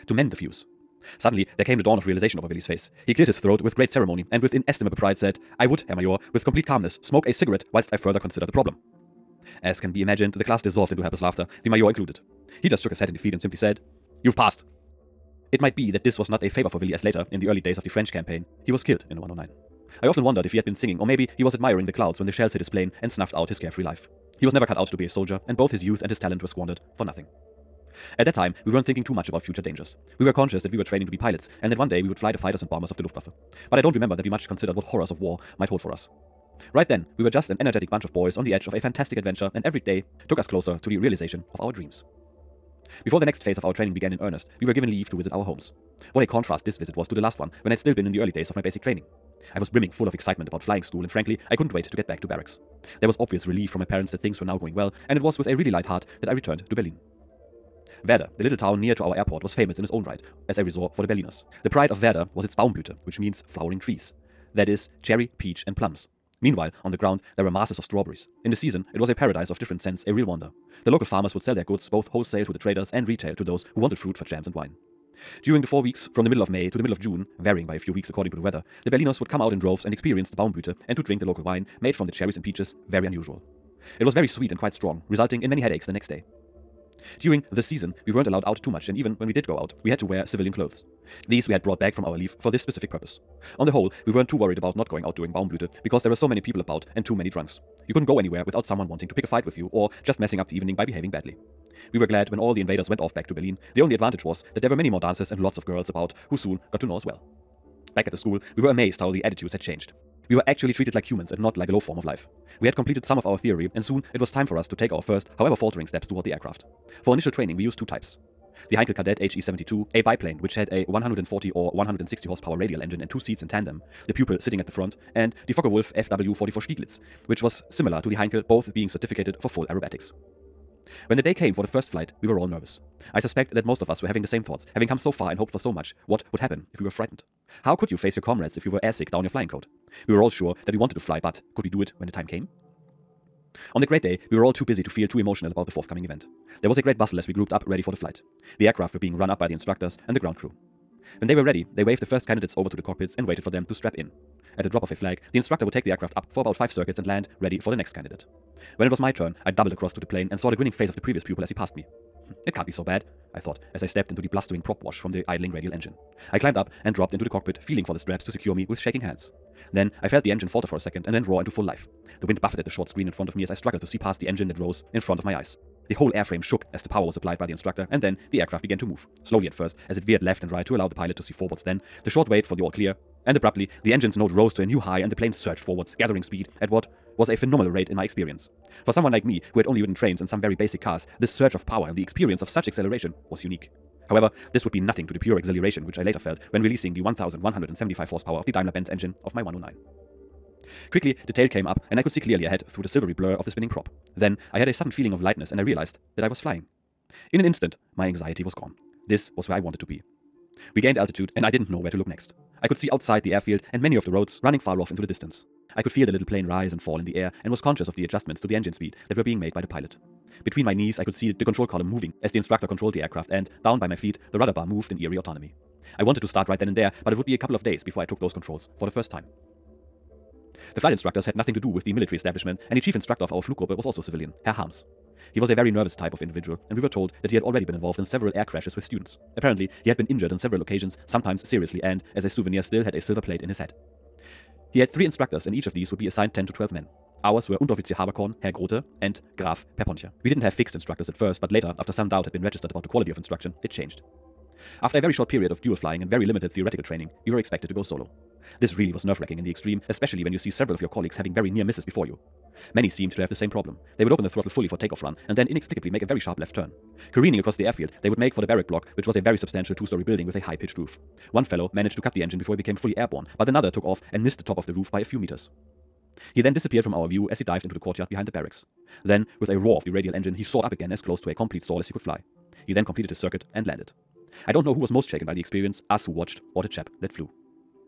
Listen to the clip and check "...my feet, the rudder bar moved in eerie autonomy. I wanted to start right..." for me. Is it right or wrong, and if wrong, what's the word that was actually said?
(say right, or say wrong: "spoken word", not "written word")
right.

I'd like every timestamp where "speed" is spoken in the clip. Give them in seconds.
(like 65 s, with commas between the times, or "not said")
186 s, 218 s.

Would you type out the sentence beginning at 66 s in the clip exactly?
Meanwhile, on the ground, there were masses of strawberries.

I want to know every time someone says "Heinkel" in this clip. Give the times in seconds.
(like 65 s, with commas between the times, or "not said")
118 s, 128 s.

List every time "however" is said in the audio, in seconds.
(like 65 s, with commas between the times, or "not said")
115 s, 194 s.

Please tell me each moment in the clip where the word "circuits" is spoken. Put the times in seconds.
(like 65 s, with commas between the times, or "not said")
156 s, 283 s.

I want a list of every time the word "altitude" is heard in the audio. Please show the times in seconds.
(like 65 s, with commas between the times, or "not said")
210 s.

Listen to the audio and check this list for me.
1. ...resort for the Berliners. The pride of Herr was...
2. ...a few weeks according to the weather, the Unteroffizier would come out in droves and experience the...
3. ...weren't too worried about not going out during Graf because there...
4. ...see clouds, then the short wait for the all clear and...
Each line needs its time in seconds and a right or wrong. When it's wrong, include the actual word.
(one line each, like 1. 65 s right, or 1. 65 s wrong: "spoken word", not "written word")
1. 60 s wrong: "Werder", not "Herr"
2. 77 s wrong: "Berliners", not "Unteroffizier"
3. 94 s wrong: "Baumblüte", not "Graf"
4. 181 s wrong: "forwards", not "clouds".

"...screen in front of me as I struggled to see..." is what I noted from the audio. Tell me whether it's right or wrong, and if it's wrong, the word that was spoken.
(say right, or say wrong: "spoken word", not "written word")
right.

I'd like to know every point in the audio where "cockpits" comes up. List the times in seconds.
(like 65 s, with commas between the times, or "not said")
152 s, 167 s.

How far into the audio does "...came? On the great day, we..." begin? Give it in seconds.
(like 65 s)
142 s.